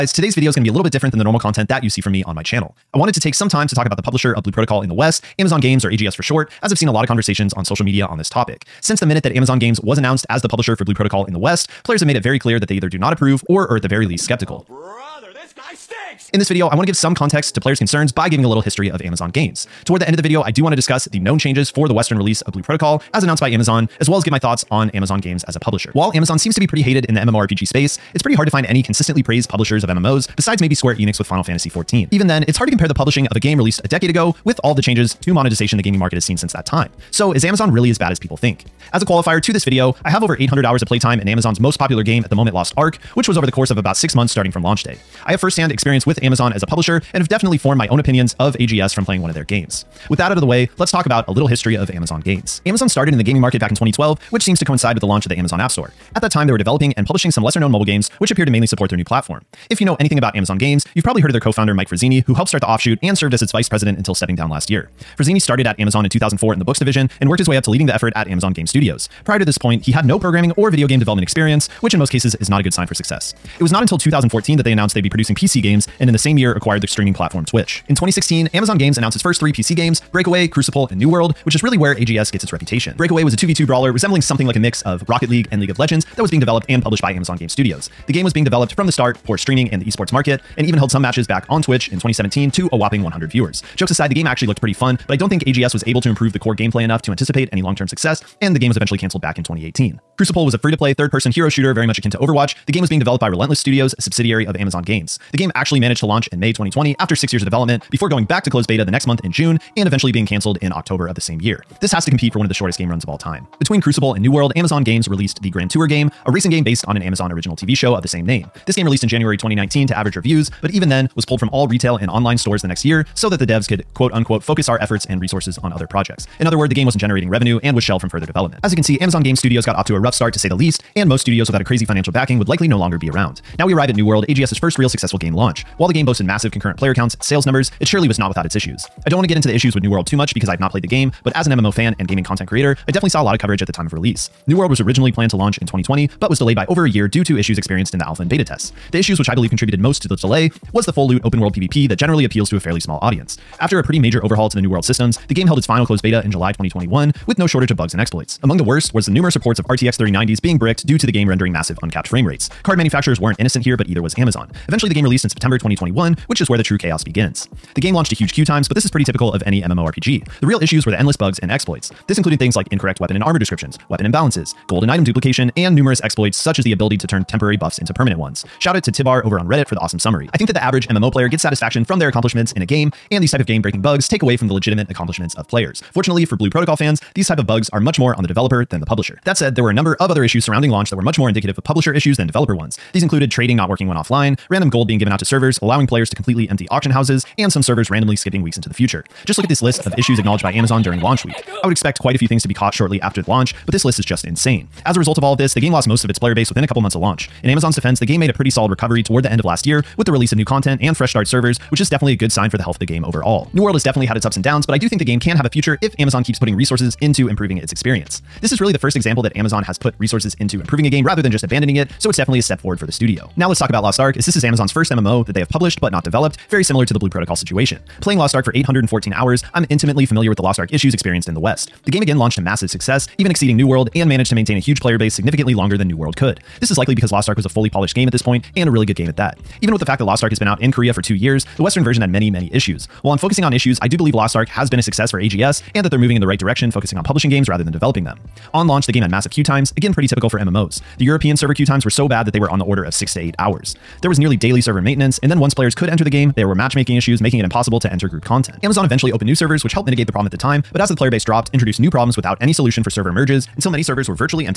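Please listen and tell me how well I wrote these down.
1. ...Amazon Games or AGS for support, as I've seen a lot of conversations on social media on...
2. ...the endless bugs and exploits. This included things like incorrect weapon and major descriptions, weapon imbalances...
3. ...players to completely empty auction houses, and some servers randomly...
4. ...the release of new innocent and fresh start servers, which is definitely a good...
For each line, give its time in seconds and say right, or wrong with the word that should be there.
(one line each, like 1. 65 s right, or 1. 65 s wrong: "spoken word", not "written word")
1. 5 s wrong: "short", not "support"
2. 170 s wrong: "armor", not "major"
3. 195 s right
4. 210 s wrong: "content", not "innocent".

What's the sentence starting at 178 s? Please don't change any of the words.
Shout out to Tibbar over on Reddit for the awesome summary.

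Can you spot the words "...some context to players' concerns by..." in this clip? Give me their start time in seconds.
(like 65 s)
16 s.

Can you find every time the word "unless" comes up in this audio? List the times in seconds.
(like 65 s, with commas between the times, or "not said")
not said.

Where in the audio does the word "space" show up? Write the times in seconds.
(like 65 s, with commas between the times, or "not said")
27 s.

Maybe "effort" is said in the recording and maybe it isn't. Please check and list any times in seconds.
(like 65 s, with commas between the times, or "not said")
67 s, 124 s.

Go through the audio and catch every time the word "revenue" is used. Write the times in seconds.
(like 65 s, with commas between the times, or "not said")
127 s.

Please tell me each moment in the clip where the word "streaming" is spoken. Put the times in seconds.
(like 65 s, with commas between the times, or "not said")
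76 s, 89 s.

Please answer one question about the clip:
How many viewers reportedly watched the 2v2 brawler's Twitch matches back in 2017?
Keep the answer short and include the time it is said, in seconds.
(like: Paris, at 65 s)
100, at 93 s.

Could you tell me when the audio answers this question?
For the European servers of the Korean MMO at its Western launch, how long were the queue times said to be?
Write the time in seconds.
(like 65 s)
252 s.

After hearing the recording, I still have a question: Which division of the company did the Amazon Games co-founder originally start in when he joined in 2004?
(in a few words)
books division.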